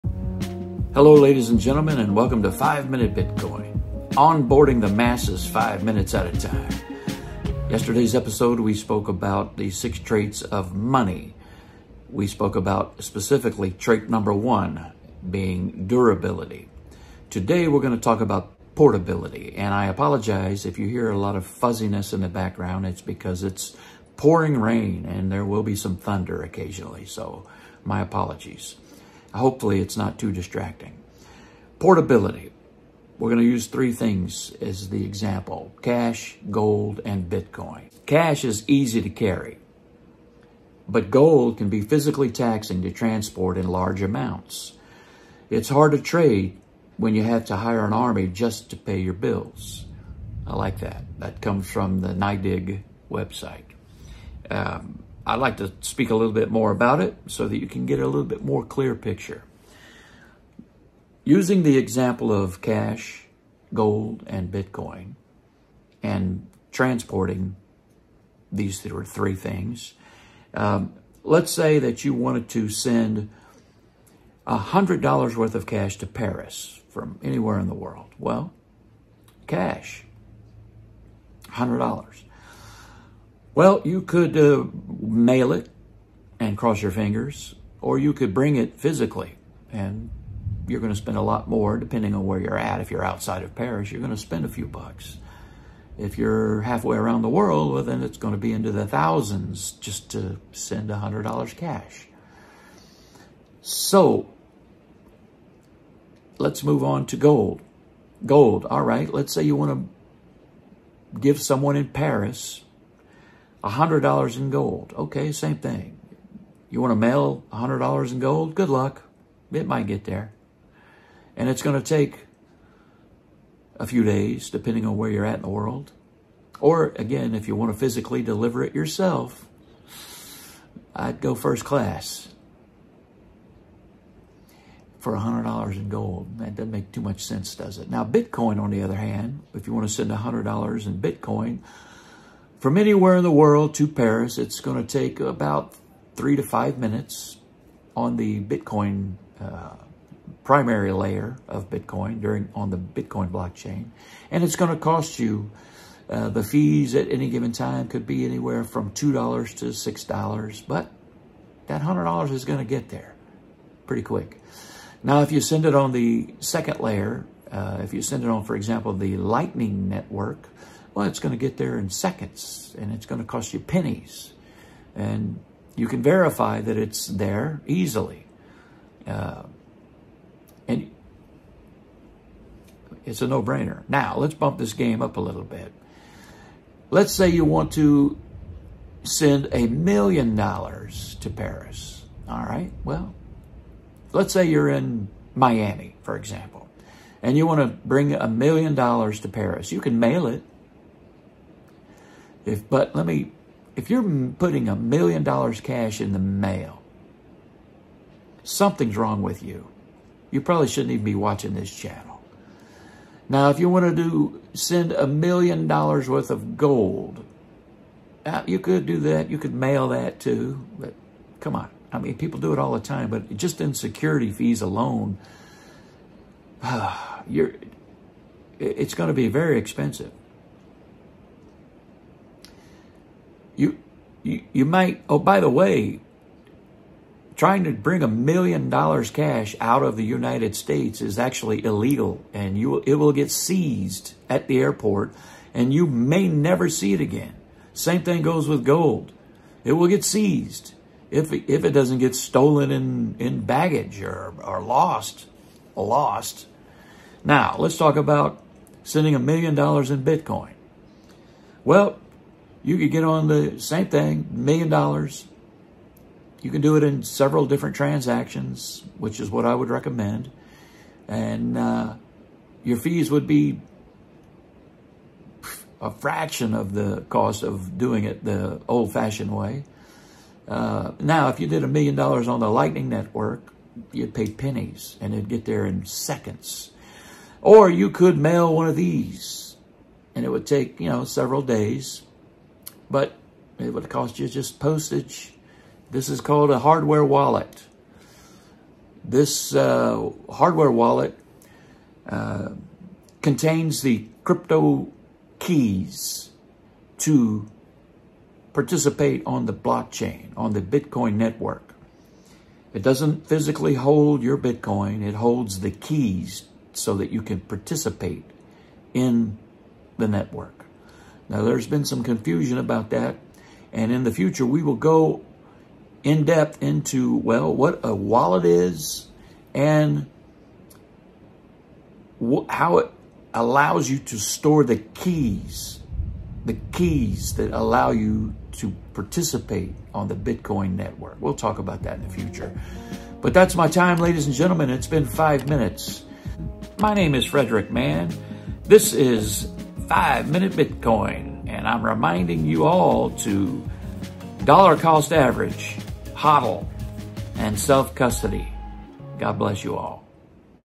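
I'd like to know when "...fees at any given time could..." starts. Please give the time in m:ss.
2:36.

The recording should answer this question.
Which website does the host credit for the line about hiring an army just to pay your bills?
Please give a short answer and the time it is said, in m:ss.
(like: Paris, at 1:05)
NYDIG, at 0:52.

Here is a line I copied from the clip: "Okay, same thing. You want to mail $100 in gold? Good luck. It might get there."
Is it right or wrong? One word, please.
right.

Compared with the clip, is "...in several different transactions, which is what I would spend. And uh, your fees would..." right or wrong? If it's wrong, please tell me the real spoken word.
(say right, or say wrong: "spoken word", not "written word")
wrong: "recommend", not "spend".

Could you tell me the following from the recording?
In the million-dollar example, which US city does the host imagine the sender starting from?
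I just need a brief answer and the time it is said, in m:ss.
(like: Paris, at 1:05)
Miami, at 3:15.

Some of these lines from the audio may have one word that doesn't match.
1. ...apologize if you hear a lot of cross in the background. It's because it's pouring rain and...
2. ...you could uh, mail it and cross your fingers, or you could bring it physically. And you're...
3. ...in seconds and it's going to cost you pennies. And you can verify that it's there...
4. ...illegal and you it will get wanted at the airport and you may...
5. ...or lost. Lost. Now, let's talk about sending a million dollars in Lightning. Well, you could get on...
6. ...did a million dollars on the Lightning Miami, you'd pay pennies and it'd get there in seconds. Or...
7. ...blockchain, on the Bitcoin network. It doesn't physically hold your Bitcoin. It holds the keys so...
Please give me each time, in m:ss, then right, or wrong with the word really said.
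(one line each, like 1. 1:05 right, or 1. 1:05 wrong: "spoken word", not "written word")
1. 0:19 wrong: "fuzziness", not "cross"
2. 1:23 right
3. 2:51 right
4. 4:01 wrong: "seized", not "wanted"
5. 4:14 wrong: "Bitcoin", not "Lightning"
6. 4:41 wrong: "Network", not "Miami"
7. 5:09 right.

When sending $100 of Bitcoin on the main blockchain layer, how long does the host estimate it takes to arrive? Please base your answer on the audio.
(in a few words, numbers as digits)
3 to 5 minutes.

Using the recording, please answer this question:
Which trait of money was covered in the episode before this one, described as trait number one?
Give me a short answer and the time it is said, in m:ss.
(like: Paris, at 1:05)
Durability, at 0:15.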